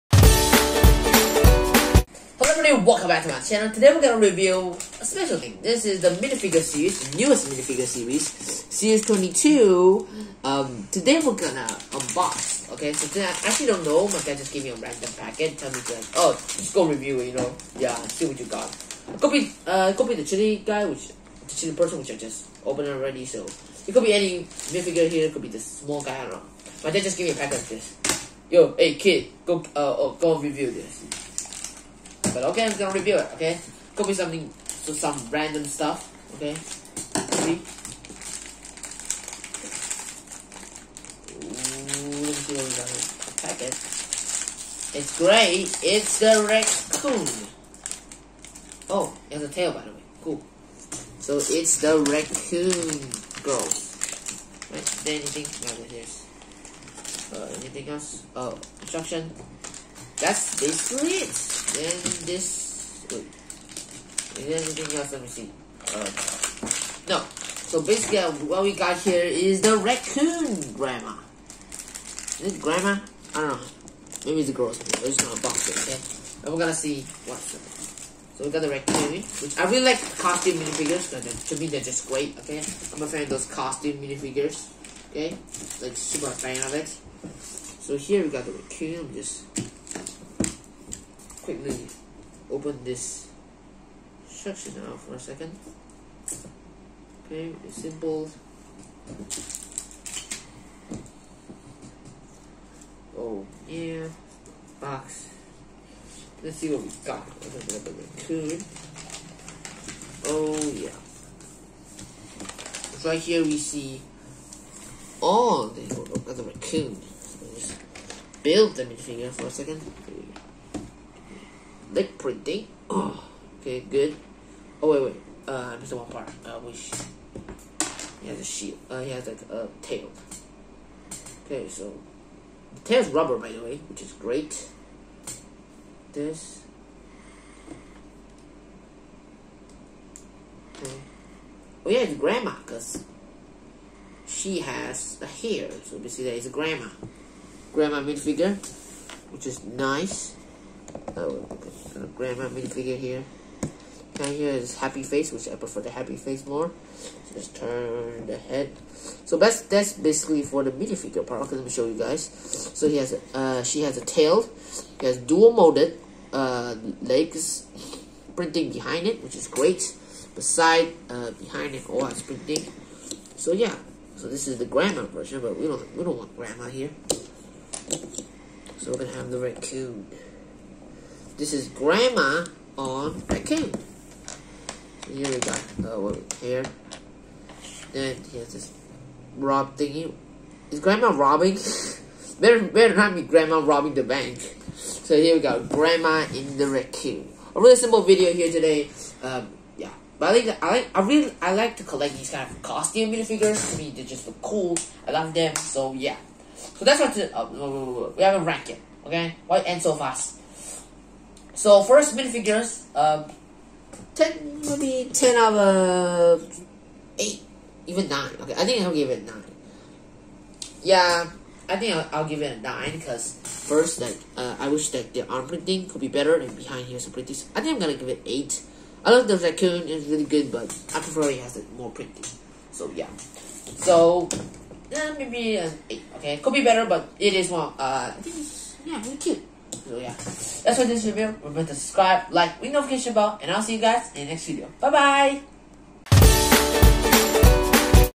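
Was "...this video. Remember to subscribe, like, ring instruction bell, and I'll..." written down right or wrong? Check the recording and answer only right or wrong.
wrong.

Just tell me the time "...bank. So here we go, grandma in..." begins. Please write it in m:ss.
3:14.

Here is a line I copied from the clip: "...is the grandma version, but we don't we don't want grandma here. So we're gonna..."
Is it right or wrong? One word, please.
right.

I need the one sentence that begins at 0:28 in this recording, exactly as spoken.
Yo, hey kid, go, uh, oh, go review this.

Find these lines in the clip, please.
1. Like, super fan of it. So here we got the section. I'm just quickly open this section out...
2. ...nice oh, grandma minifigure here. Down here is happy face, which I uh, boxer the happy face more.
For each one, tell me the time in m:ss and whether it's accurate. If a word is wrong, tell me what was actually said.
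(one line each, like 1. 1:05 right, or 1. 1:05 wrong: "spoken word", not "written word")
1. 1:25 wrong: "raccoon", not "section"
2. 2:29 wrong: "prefer", not "boxer".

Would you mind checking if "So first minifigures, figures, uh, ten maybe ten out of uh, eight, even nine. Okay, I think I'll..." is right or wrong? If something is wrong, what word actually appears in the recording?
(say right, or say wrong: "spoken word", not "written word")
right.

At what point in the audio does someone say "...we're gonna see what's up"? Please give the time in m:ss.
1:16.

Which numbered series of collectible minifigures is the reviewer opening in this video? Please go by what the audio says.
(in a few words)
22.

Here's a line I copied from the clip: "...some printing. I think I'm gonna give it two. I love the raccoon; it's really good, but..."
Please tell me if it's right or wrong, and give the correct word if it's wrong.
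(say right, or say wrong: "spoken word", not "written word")
wrong: "eight", not "two".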